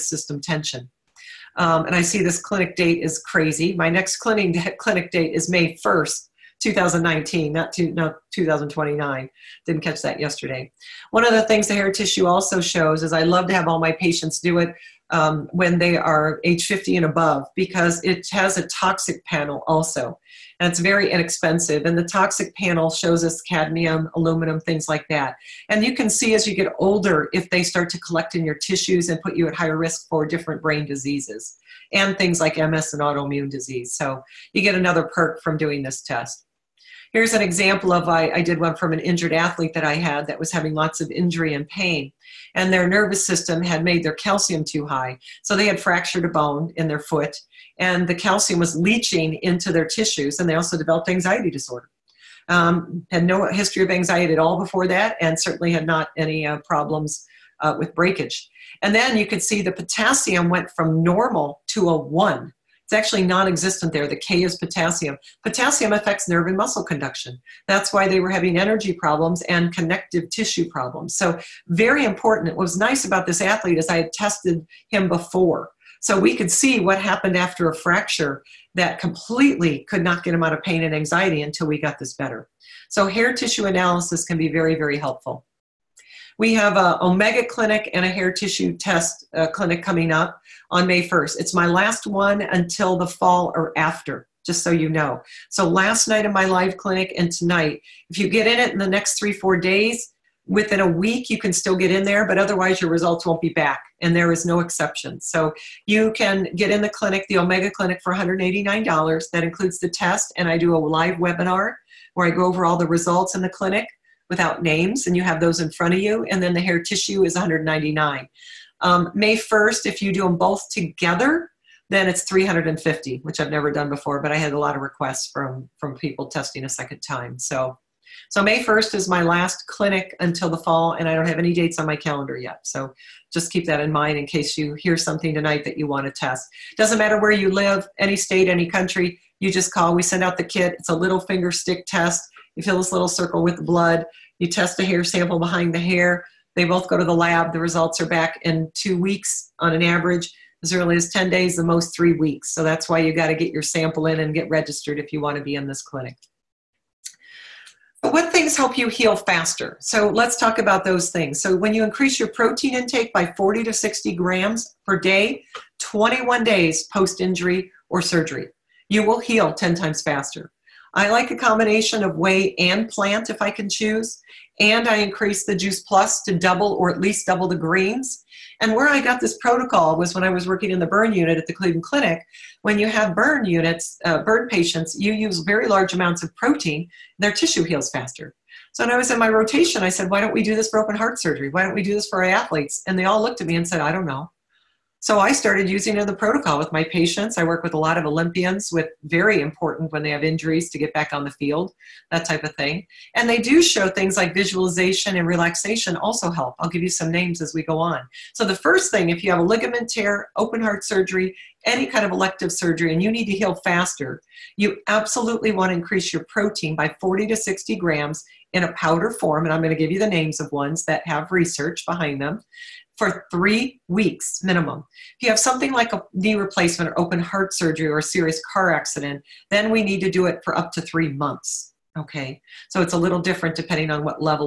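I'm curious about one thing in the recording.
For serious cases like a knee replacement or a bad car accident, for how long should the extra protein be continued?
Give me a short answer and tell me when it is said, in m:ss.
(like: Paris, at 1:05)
up to three months, at 3:50.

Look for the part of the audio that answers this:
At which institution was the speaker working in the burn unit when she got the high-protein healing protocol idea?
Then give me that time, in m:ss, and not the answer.
3:01.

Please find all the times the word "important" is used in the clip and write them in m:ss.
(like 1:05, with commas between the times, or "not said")
1:12, 3:19.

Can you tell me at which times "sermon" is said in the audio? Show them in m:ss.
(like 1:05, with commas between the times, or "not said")
not said.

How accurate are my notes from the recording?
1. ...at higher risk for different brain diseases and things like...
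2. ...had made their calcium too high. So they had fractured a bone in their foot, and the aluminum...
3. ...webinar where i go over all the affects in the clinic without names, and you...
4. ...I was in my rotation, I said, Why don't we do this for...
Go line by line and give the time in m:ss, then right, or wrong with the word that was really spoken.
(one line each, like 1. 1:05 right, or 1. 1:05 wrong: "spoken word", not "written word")
1. 0:29 right
2. 0:43 wrong: "calcium", not "aluminum"
3. 1:51 wrong: "results", not "affects"
4. 3:08 right.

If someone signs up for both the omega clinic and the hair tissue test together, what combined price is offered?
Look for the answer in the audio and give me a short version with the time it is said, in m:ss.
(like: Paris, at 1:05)
$350, at 2:02.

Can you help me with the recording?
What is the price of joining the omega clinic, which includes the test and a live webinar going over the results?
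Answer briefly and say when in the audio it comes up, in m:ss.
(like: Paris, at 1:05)
$189, at 1:48.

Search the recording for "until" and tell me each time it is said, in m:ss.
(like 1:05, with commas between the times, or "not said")
1:21, 1:32, 2:10.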